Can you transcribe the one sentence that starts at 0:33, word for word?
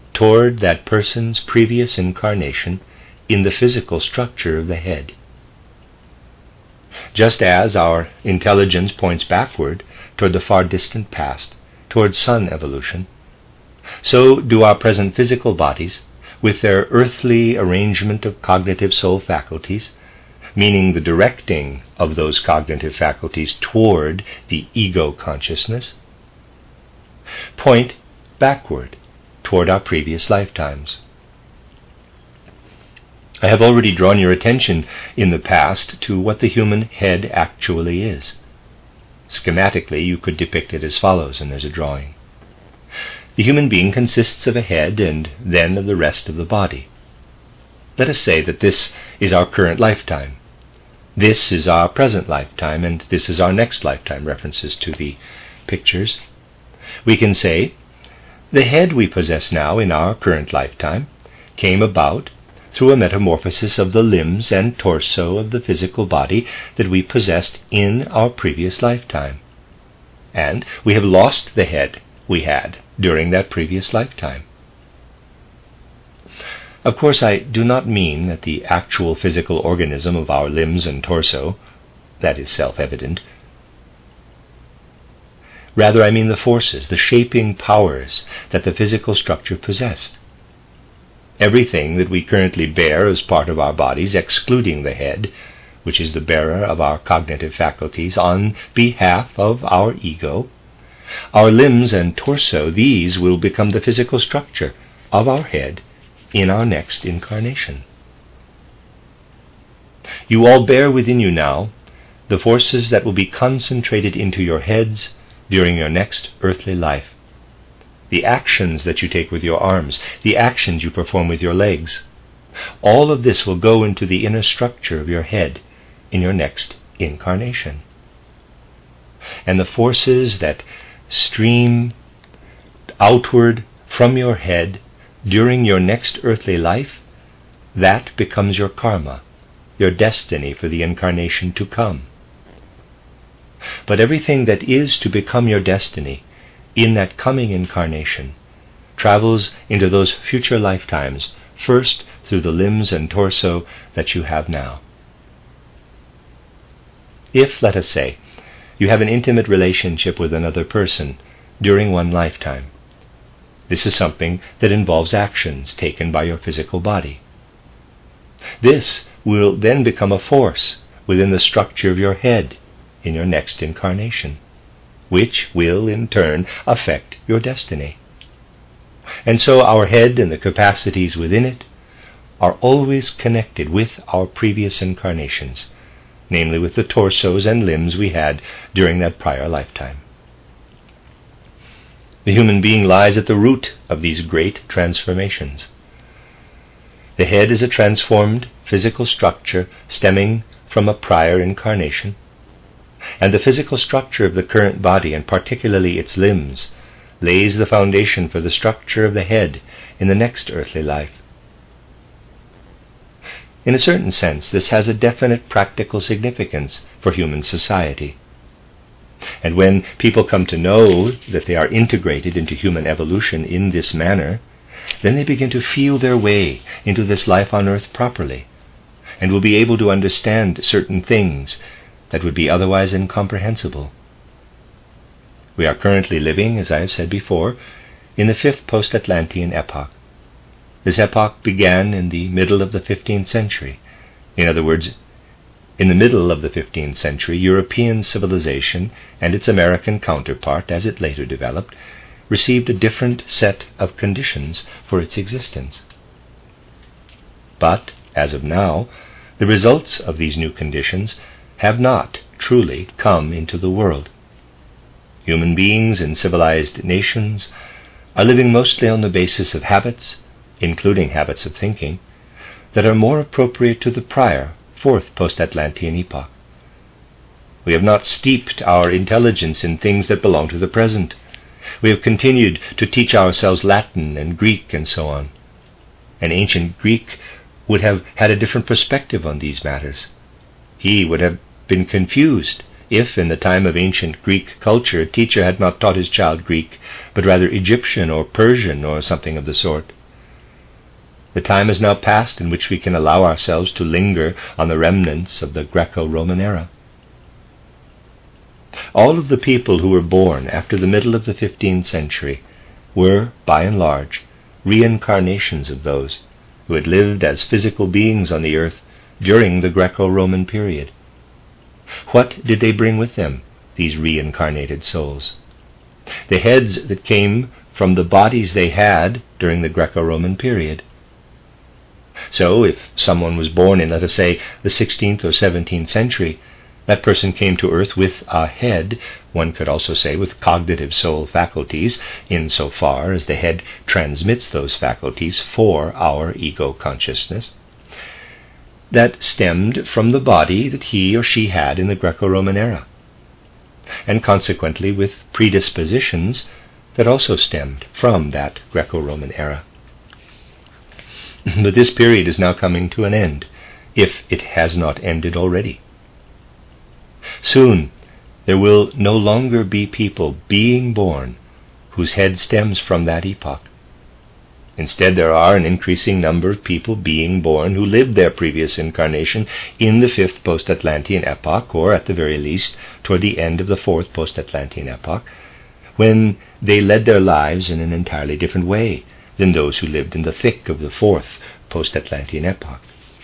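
I have already drawn your attention in the past to what the human head actually is.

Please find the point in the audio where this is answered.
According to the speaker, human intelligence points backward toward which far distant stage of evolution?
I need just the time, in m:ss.
0:12.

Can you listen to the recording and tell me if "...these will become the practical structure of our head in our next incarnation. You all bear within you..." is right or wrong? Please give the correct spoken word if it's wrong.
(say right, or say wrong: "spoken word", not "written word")
wrong: "physical", not "practical".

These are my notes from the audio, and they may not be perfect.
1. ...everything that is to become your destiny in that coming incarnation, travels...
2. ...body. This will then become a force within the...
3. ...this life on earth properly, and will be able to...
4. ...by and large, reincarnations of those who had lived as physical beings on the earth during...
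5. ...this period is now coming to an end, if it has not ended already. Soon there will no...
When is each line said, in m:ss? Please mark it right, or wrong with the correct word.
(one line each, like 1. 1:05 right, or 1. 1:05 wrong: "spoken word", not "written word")
1. 2:24 right
2. 2:46 right
3. 3:47 right
4. 5:13 right
5. 6:01 right.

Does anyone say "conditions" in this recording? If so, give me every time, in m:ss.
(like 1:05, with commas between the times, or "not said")
4:13, 4:20.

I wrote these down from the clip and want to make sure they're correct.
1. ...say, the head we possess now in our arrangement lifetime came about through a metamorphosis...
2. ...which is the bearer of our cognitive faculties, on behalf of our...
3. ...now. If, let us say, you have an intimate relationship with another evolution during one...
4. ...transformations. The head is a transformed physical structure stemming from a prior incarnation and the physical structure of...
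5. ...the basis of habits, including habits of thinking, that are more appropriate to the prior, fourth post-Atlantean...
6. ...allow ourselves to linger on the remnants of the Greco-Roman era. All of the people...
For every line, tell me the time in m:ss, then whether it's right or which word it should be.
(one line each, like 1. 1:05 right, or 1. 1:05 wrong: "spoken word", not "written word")
1. 0:57 wrong: "current", not "arrangement"
2. 1:35 right
3. 2:34 wrong: "person", not "evolution"
4. 3:14 right
5. 4:29 right
6. 5:02 right.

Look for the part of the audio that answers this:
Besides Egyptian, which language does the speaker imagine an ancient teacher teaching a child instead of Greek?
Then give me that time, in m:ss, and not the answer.
4:58.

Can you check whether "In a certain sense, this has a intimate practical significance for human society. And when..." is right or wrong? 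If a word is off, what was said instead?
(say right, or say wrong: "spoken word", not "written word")
wrong: "definite", not "intimate".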